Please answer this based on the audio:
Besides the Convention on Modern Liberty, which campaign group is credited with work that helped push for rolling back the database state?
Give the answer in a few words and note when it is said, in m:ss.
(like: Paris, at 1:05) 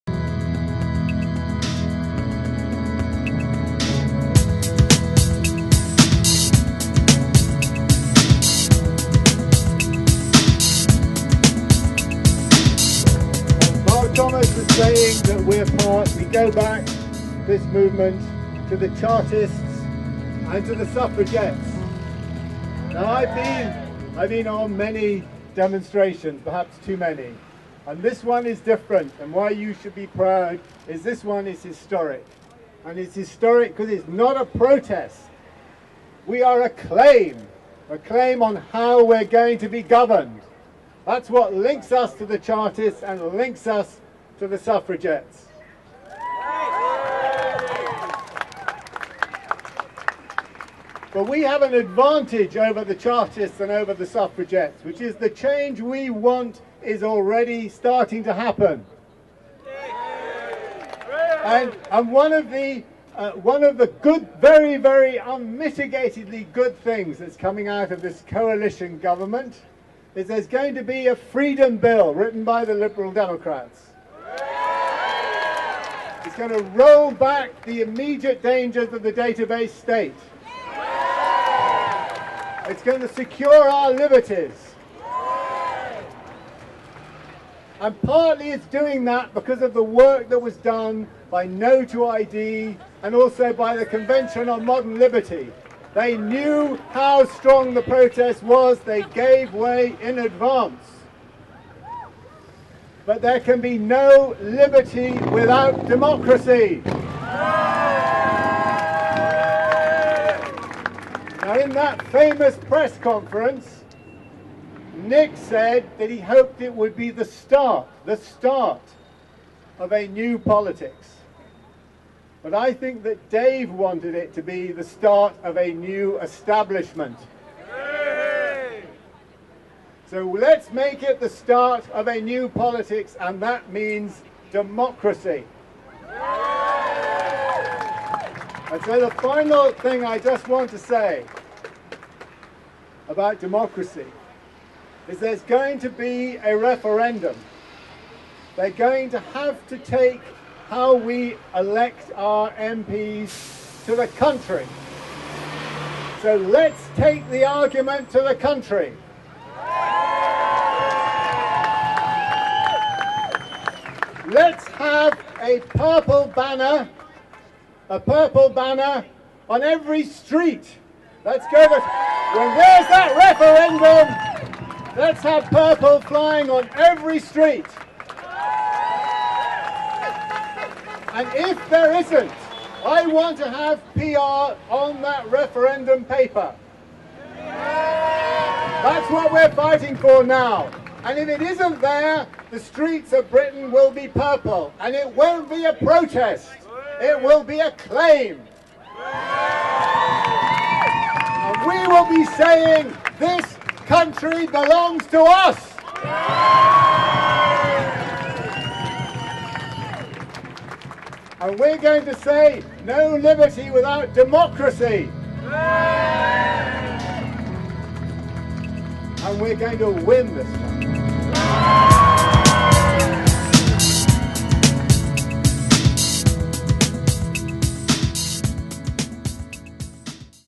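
No to ID, at 1:31.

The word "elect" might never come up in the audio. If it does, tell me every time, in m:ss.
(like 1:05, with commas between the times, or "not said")
2:31.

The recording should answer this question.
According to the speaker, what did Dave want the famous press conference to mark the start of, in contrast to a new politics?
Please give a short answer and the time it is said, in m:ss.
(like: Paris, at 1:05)
a new establishment, at 2:05.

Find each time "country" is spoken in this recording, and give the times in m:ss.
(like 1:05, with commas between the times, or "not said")
2:34, 2:38, 3:23.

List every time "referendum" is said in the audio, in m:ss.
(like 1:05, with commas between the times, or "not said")
2:26, 2:54, 3:05.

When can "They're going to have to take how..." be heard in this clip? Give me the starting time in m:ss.
2:28.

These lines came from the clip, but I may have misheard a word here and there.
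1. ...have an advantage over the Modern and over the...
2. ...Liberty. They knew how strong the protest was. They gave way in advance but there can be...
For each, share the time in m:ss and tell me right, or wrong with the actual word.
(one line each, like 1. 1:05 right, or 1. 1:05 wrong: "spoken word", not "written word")
1. 0:51 wrong: "Chartists", not "Modern"
2. 1:34 right.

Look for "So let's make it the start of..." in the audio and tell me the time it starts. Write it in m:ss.
2:10.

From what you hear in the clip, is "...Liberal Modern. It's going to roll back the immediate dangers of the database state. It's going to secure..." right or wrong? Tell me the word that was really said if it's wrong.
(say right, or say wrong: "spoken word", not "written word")
wrong: "Democrats", not "Modern".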